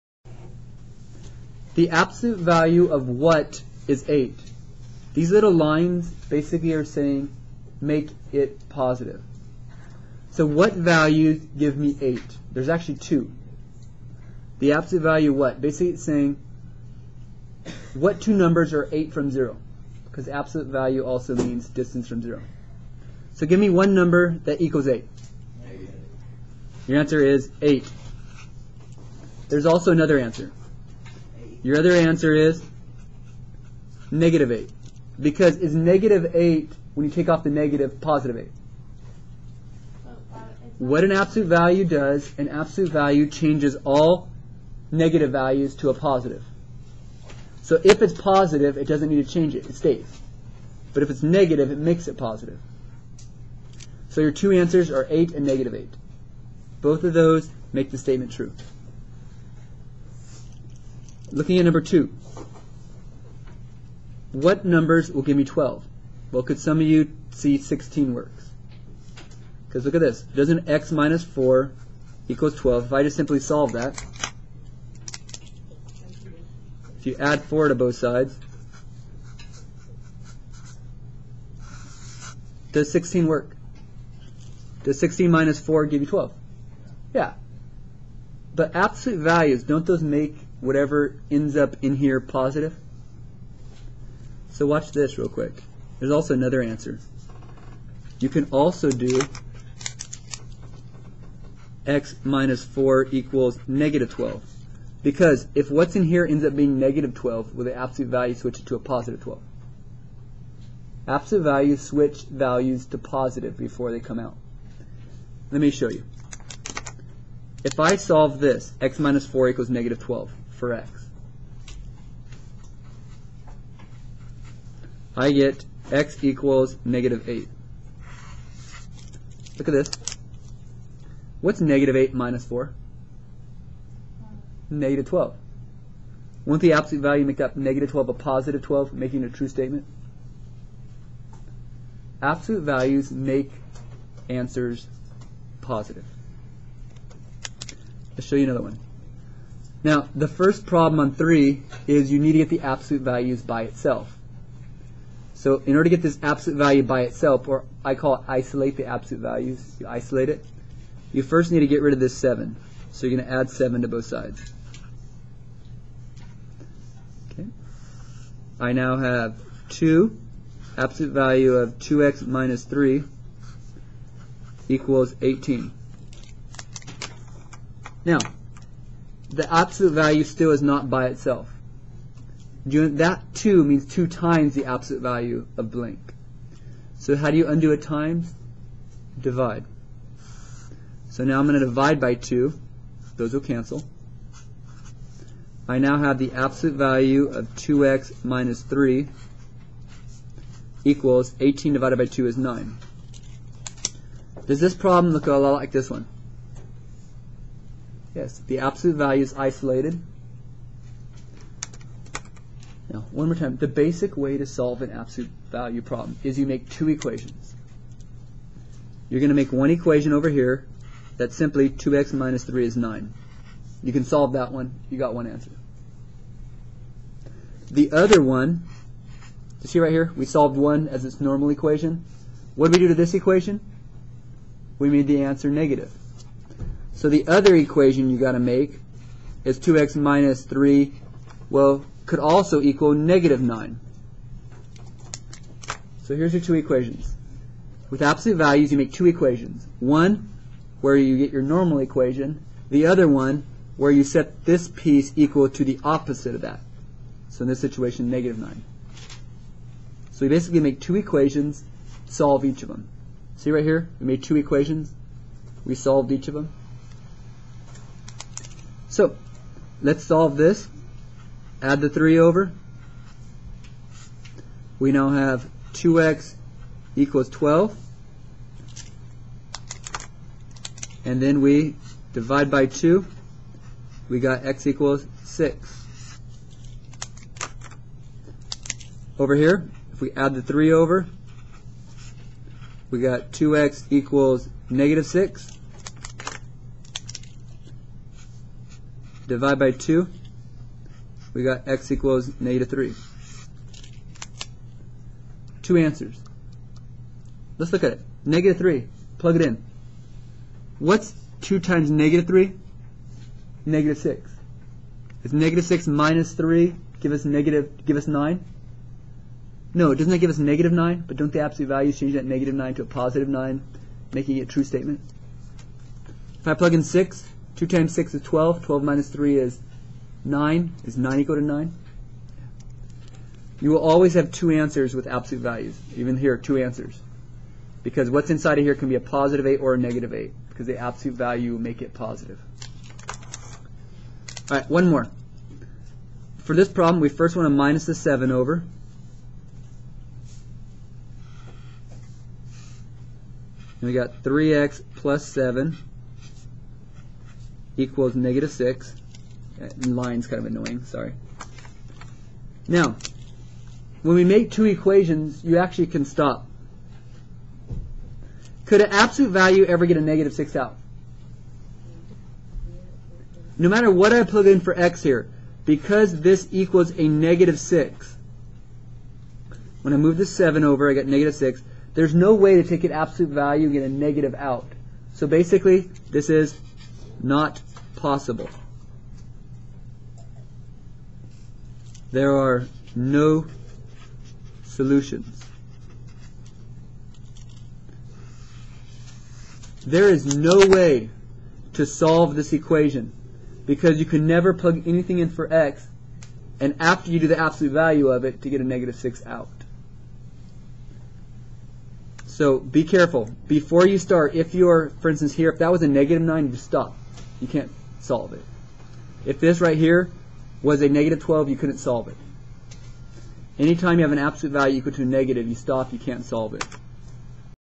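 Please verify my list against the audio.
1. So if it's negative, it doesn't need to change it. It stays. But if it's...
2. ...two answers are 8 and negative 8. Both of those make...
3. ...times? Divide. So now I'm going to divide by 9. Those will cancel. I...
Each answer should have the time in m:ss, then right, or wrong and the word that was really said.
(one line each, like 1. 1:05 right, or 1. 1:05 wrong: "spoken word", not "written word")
1. 0:47 wrong: "positive", not "negative"
2. 0:54 right
3. 3:07 wrong: "2", not "9".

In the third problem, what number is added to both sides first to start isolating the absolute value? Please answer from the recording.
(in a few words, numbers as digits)
7.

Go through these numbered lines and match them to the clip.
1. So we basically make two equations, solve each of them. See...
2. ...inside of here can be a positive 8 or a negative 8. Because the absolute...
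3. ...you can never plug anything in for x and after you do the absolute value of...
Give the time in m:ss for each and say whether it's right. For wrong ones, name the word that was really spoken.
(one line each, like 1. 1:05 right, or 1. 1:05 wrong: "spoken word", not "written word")
1. 4:20 right
2. 5:38 right
3. 6:43 right.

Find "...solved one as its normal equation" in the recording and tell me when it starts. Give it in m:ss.
3:50.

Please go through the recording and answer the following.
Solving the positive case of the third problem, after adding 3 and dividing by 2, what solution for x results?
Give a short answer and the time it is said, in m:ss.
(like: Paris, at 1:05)
6, at 4:44.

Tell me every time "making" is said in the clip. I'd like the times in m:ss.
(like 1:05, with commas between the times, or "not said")
2:18, 5:24.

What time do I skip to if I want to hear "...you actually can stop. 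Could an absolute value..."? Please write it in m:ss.
6:05.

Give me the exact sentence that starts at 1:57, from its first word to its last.
If I solve this, x minus 4 equals negative 12 for x.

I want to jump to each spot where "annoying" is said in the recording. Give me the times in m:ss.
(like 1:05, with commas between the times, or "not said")
6:00.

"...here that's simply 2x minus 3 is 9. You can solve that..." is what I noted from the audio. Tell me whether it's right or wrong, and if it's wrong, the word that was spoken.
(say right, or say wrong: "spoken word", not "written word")
right.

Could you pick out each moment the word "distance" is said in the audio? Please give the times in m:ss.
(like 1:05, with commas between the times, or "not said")
0:21.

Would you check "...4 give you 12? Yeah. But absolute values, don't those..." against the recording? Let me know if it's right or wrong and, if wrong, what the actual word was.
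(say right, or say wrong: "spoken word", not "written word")
right.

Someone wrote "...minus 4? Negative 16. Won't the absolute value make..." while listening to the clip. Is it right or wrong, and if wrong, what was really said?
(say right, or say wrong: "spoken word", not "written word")
wrong: "12", not "16".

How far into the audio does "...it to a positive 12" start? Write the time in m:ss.
1:48.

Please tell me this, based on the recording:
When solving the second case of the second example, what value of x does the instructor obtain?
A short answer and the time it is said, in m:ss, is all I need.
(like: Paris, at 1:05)
-8, at 2:05.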